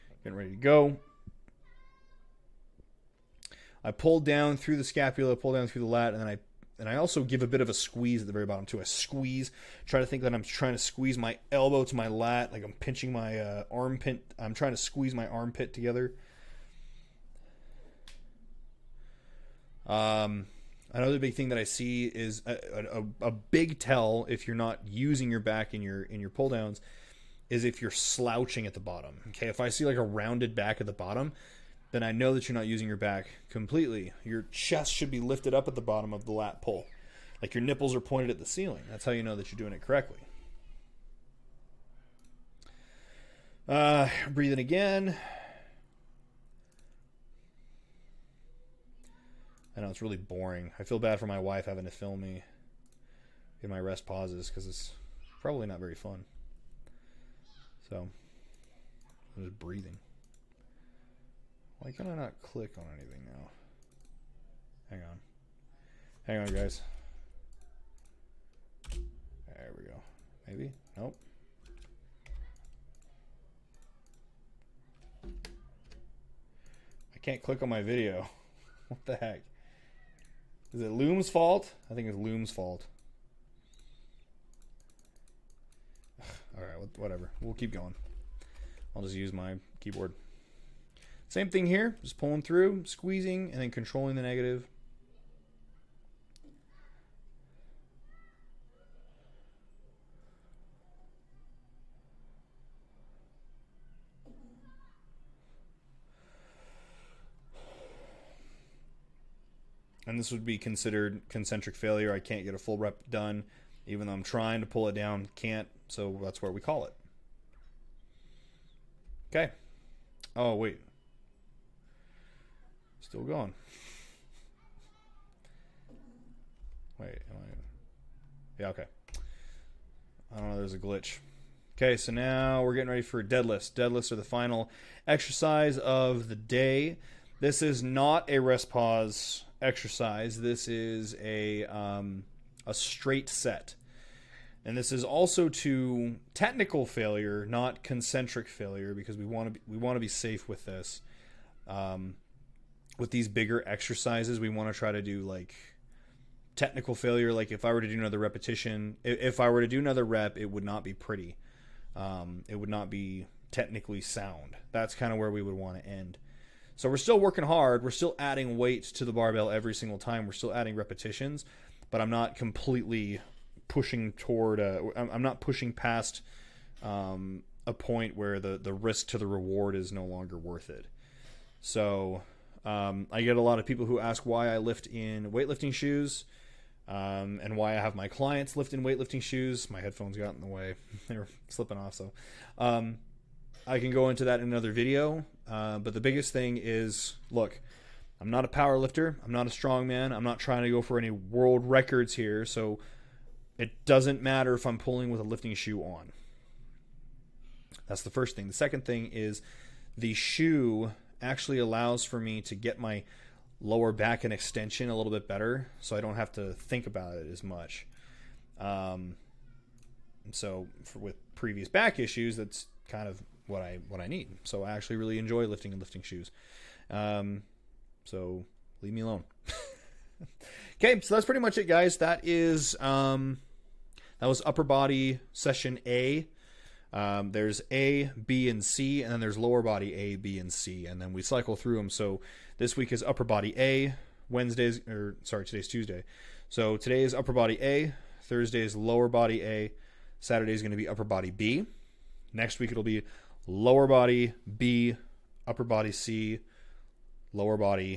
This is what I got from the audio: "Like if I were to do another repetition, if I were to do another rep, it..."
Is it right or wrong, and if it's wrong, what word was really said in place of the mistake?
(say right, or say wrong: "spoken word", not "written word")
right.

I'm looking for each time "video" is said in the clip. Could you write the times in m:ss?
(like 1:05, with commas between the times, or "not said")
1:17, 3:14.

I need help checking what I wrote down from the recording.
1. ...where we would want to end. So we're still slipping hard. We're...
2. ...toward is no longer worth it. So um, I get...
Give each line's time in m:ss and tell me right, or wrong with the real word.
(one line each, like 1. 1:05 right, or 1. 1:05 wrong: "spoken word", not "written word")
1. 2:45 wrong: "working", not "slipping"
2. 2:59 wrong: "reward", not "toward".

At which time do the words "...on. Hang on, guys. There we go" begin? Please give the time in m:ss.
1:05.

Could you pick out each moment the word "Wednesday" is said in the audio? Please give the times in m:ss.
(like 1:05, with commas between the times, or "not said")
4:04.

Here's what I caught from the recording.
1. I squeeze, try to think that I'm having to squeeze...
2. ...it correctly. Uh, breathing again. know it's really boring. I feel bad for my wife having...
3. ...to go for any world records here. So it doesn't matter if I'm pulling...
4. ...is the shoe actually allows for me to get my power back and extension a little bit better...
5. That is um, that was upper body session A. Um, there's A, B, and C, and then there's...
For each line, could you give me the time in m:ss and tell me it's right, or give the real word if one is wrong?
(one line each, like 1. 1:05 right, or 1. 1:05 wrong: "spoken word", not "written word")
1. 0:08 wrong: "trying", not "having"
2. 0:39 right
3. 3:20 right
4. 3:29 wrong: "lower", not "power"
5. 3:51 right.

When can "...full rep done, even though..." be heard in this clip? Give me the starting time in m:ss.
1:52.